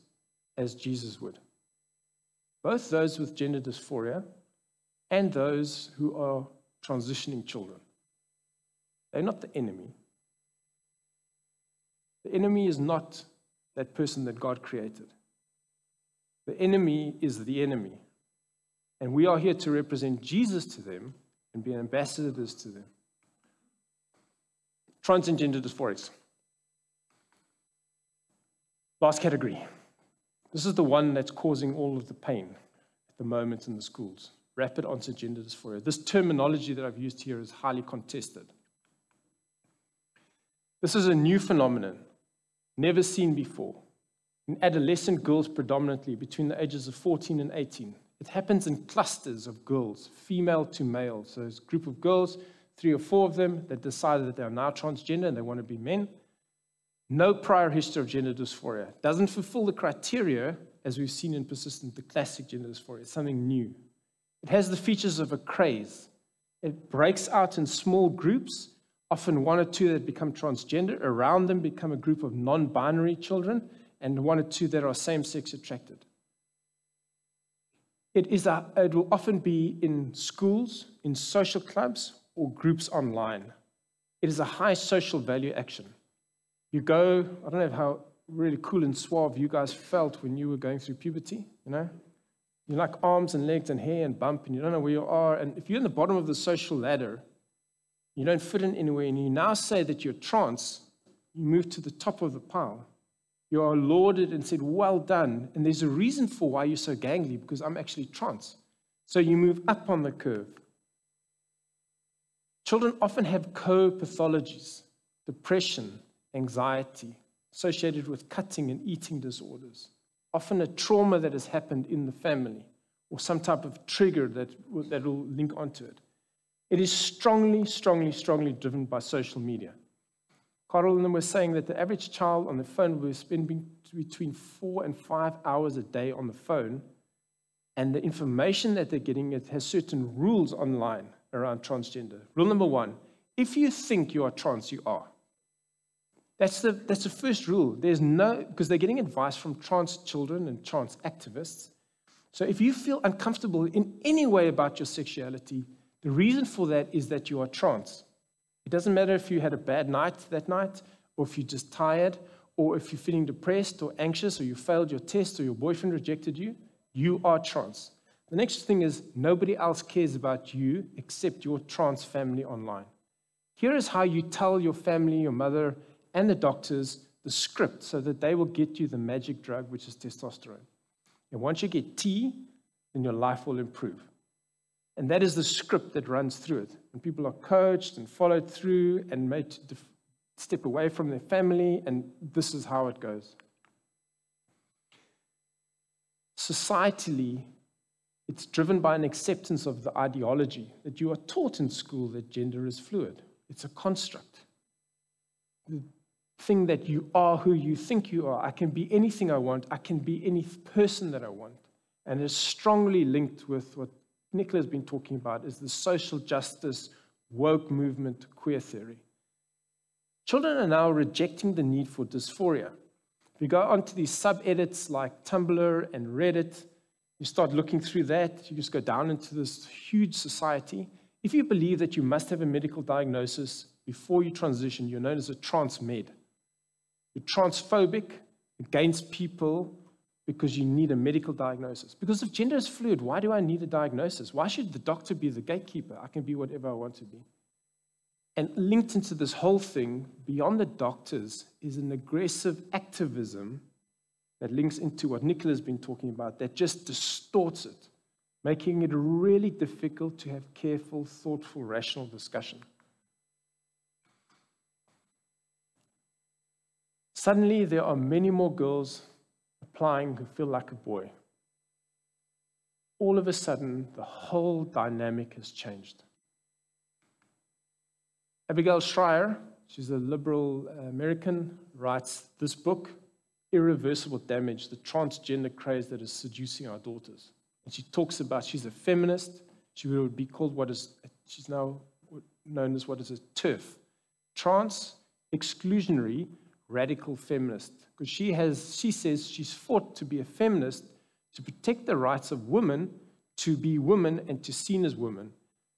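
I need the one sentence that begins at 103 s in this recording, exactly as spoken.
You are lauded and said, Well done.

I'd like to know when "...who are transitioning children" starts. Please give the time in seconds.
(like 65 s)
5 s.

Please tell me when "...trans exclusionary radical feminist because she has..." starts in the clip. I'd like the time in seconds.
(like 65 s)
294 s.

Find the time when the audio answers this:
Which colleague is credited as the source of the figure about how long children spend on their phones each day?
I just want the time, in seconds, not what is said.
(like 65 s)
130 s.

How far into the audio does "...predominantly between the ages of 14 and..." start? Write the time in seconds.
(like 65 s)
45 s.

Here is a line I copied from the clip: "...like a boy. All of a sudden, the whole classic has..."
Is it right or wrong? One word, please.
wrong.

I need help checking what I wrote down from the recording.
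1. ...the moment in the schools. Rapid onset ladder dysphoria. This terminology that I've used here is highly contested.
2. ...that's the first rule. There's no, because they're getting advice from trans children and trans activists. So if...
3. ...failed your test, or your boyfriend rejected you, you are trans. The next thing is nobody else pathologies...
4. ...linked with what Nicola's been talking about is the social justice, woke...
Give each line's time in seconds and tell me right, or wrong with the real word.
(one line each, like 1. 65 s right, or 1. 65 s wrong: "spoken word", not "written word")
1. 33 s wrong: "gender", not "ladder"
2. 146 s right
3. 164 s wrong: "cares", not "pathologies"
4. 213 s right.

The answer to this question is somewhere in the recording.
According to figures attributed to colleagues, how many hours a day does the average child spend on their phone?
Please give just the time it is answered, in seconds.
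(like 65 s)
134 s.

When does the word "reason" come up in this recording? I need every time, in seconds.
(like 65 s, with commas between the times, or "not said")
105 s, 156 s.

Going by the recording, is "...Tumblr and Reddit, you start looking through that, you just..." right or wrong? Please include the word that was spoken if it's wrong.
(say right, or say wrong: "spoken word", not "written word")
right.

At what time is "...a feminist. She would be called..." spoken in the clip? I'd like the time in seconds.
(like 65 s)
288 s.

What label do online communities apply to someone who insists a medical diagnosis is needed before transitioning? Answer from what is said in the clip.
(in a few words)
trans med.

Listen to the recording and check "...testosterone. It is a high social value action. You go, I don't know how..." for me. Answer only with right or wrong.
wrong.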